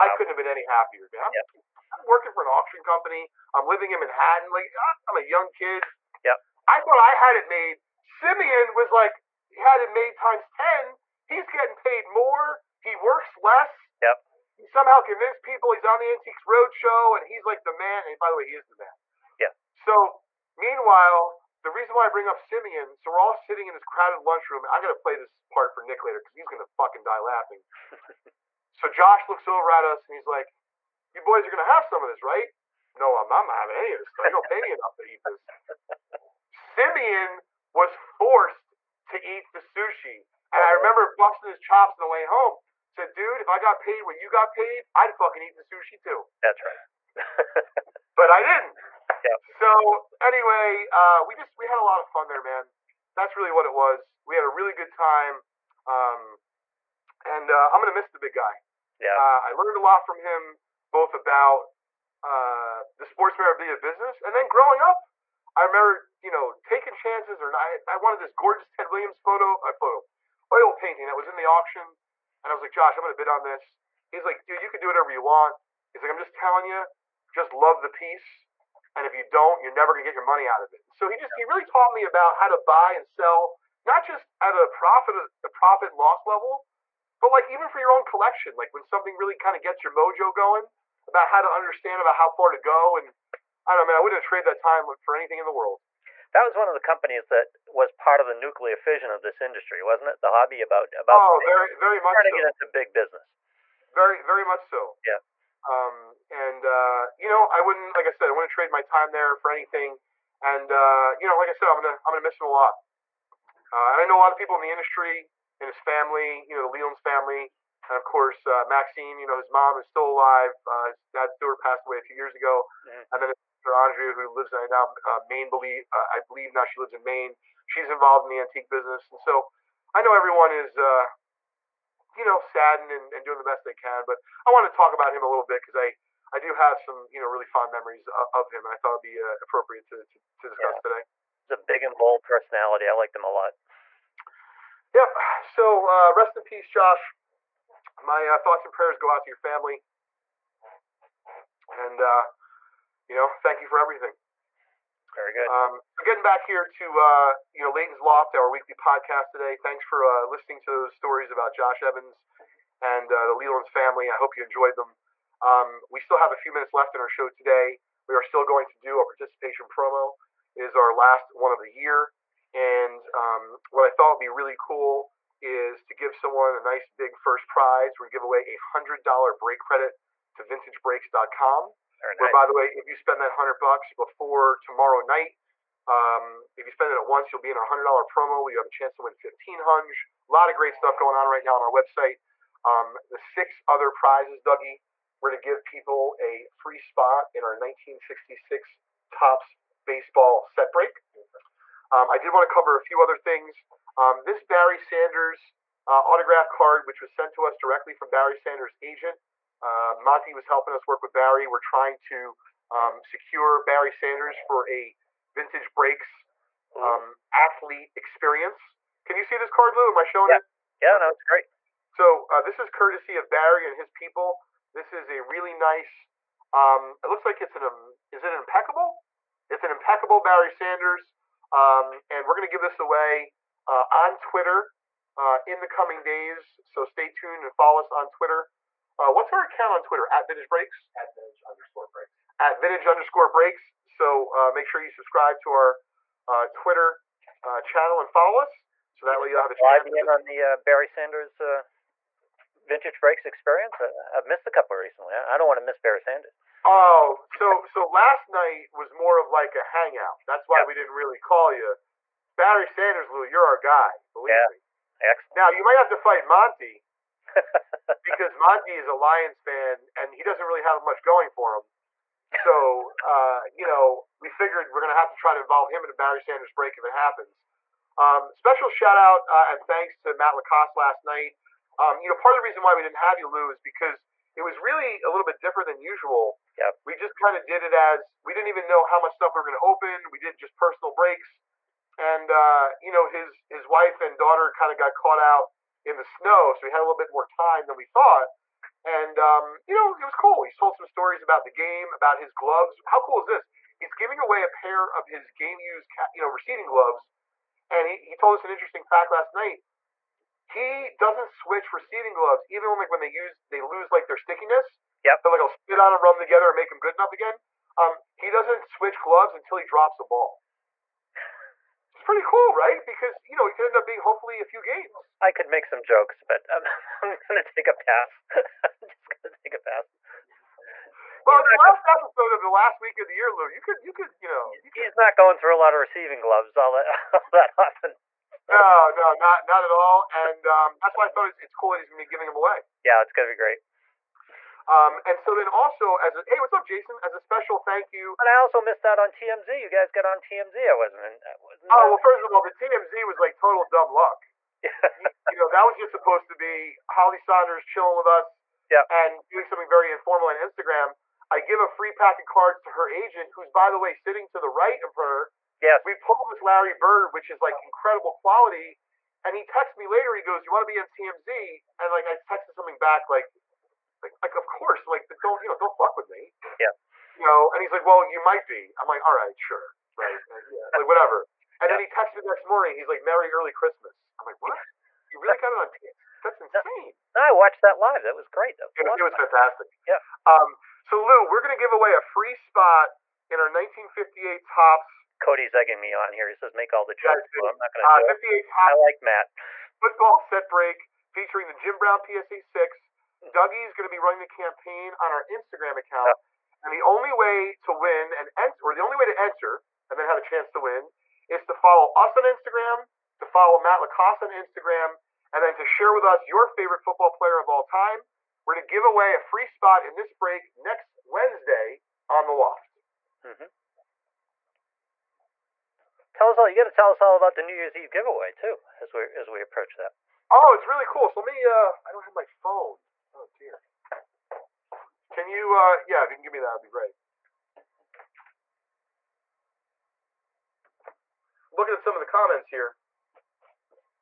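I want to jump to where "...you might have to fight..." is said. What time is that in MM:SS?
04:25.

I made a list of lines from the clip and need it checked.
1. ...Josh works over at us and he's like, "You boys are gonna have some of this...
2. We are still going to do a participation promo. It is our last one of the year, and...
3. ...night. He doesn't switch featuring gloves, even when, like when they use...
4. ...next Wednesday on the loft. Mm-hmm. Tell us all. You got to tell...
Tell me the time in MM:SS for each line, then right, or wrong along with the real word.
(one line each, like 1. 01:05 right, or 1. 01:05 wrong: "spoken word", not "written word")
1. 00:28 wrong: "looks", not "works"
2. 02:48 right
3. 05:09 wrong: "receiving", not "featuring"
4. 07:00 right.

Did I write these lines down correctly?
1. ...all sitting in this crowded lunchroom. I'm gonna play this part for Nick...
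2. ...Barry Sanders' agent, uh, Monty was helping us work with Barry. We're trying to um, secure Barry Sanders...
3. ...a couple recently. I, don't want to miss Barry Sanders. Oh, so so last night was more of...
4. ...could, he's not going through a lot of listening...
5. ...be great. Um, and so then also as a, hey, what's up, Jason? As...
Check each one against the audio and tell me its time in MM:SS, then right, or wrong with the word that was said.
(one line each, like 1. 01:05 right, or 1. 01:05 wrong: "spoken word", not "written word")
1. 00:23 right
2. 03:28 right
3. 04:14 right
4. 05:34 wrong: "receiving", not "listening"
5. 05:43 right.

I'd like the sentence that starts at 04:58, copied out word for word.
And um, you know, it was cool.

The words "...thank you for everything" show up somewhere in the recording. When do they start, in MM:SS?
02:33.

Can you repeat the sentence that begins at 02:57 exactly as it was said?
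We're gonna give away a hundred dollar break credit to VintageBreaks.com very Where, nice.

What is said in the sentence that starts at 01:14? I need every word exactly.
He's like, dude, you can do whatever you want.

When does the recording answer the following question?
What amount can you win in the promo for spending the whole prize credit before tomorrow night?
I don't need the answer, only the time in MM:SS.
03:09.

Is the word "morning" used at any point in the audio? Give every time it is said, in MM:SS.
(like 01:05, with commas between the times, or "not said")
06:22.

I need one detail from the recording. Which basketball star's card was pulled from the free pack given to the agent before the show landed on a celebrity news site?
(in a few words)
Larry Bird.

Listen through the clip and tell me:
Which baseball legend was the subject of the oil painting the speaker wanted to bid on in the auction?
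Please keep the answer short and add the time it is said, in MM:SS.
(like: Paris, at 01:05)
Ted Williams, at 01:08.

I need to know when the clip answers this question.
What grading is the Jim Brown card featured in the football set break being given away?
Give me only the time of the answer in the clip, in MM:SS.
06:42.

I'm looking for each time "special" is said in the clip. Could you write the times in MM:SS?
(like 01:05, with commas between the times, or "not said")
04:38, 05:47.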